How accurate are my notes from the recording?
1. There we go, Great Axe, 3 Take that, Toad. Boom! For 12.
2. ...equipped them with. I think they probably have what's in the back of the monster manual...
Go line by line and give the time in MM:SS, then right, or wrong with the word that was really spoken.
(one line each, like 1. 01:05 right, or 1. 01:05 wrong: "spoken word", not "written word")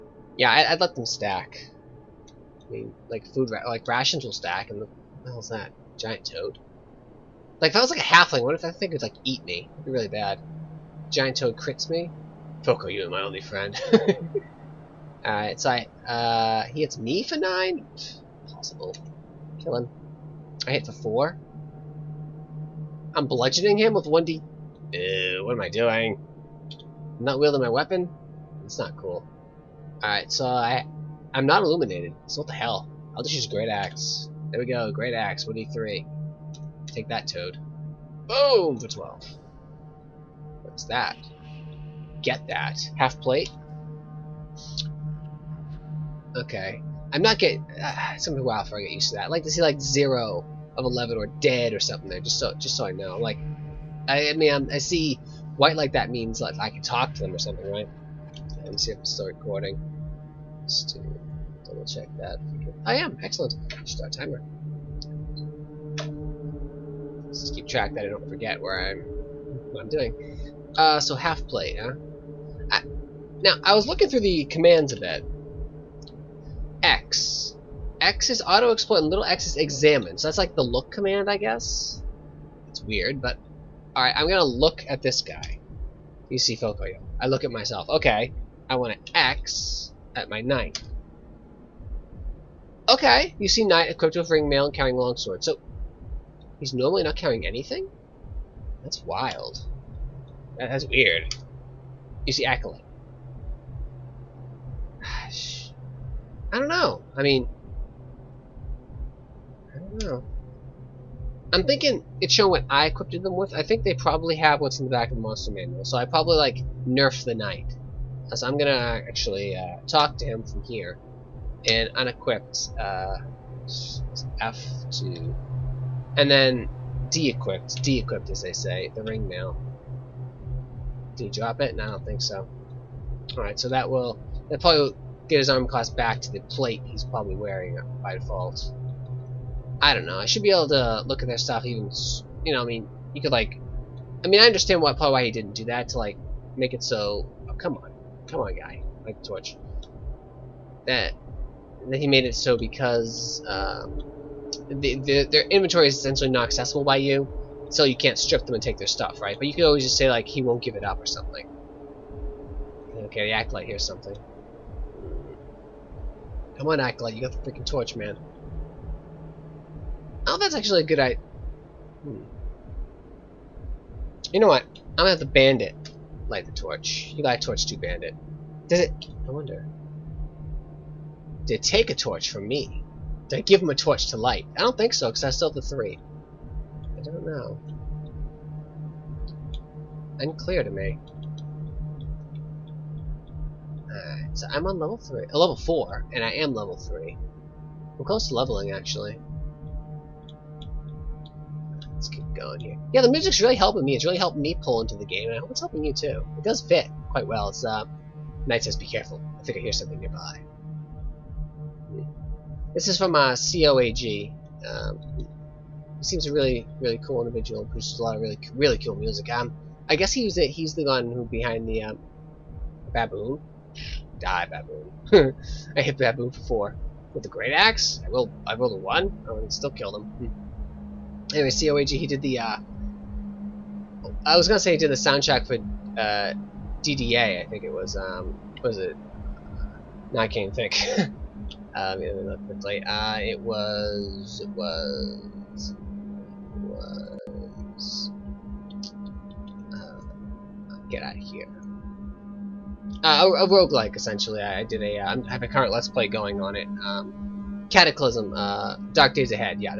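1. 00:34 right
2. 01:52 right.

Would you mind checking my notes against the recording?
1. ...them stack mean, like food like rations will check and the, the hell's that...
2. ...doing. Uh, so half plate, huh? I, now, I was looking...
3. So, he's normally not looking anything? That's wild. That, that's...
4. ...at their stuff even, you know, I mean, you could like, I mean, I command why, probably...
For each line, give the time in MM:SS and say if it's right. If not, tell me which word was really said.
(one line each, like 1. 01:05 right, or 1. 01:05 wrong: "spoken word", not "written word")
1. 00:00 wrong: "stack", not "check"
2. 01:09 right
3. 01:35 wrong: "carrying", not "looking"
4. 02:21 wrong: "understand", not "command".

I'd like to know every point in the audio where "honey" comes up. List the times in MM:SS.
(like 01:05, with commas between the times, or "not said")
not said.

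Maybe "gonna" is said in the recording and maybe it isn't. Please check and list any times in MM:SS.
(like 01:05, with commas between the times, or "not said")
00:48, 01:24, 01:58, 02:54, 03:54.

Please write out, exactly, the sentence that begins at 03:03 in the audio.
Did I give him a torch to light?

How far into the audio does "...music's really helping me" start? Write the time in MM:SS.
03:23.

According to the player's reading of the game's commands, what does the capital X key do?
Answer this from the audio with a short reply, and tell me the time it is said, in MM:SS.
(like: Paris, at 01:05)
auto-explore, at 01:18.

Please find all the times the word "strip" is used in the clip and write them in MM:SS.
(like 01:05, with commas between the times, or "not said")
02:38.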